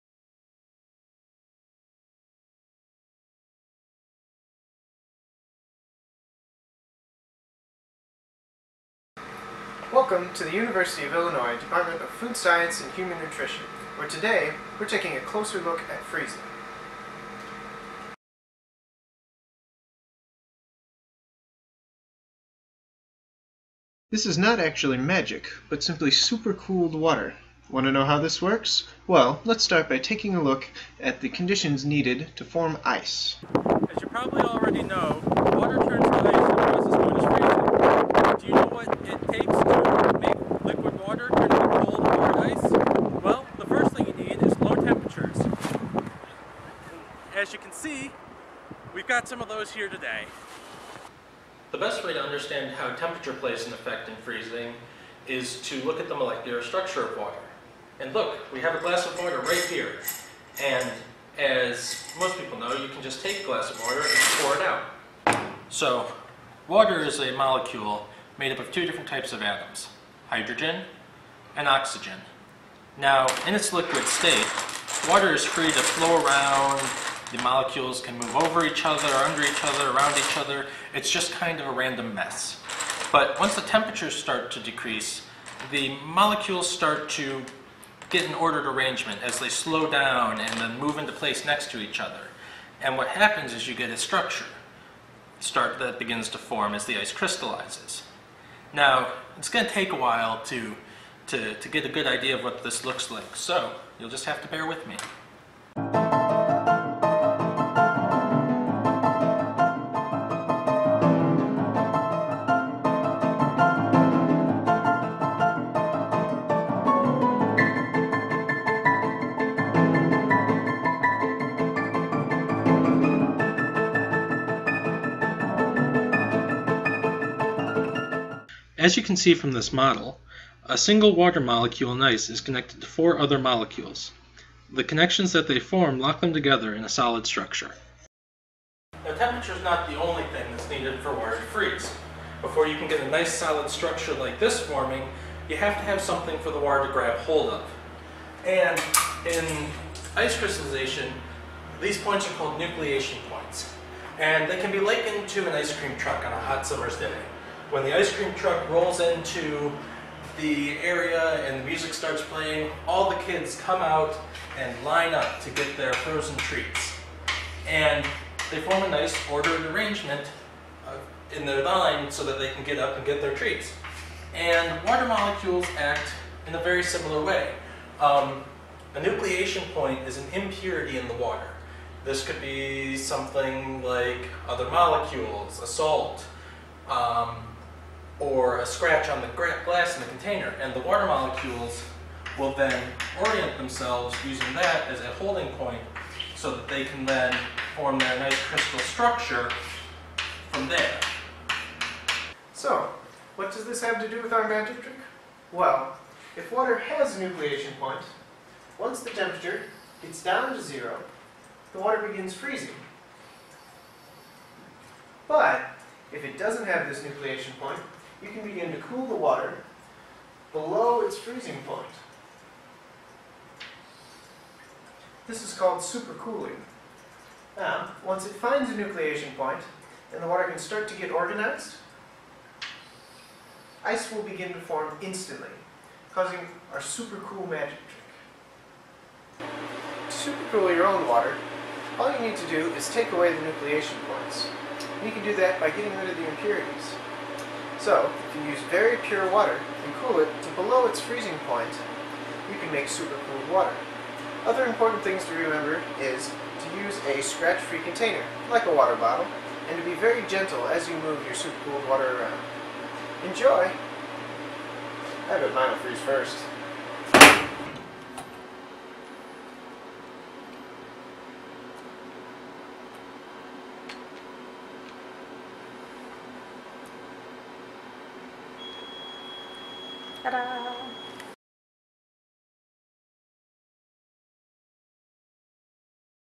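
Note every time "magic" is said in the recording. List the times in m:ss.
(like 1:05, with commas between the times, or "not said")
0:24, 3:24, 3:57.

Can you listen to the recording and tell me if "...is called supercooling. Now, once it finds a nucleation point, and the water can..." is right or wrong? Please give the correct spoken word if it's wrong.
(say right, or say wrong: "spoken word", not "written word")
right.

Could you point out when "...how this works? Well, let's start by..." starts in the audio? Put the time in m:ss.
0:28.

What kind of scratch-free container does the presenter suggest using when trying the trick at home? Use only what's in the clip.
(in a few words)
A water bottle.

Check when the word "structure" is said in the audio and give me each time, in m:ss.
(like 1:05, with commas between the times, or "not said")
0:56, 1:33, 2:17, 2:23, 3:18.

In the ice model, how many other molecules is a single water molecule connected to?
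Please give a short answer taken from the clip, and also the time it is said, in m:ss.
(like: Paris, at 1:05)
4, at 2:12.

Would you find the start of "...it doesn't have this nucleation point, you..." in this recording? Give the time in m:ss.
3:36.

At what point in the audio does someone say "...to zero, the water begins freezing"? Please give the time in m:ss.
3:30.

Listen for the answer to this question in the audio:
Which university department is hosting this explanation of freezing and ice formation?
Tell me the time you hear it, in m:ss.
0:12.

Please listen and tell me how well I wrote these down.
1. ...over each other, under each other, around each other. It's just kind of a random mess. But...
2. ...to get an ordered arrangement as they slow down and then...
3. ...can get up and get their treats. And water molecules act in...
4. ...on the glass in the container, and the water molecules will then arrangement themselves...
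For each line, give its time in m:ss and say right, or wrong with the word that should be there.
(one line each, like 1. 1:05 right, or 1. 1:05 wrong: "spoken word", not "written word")
1. 1:18 right
2. 1:27 right
3. 2:52 right
4. 3:09 wrong: "orient", not "arrangement".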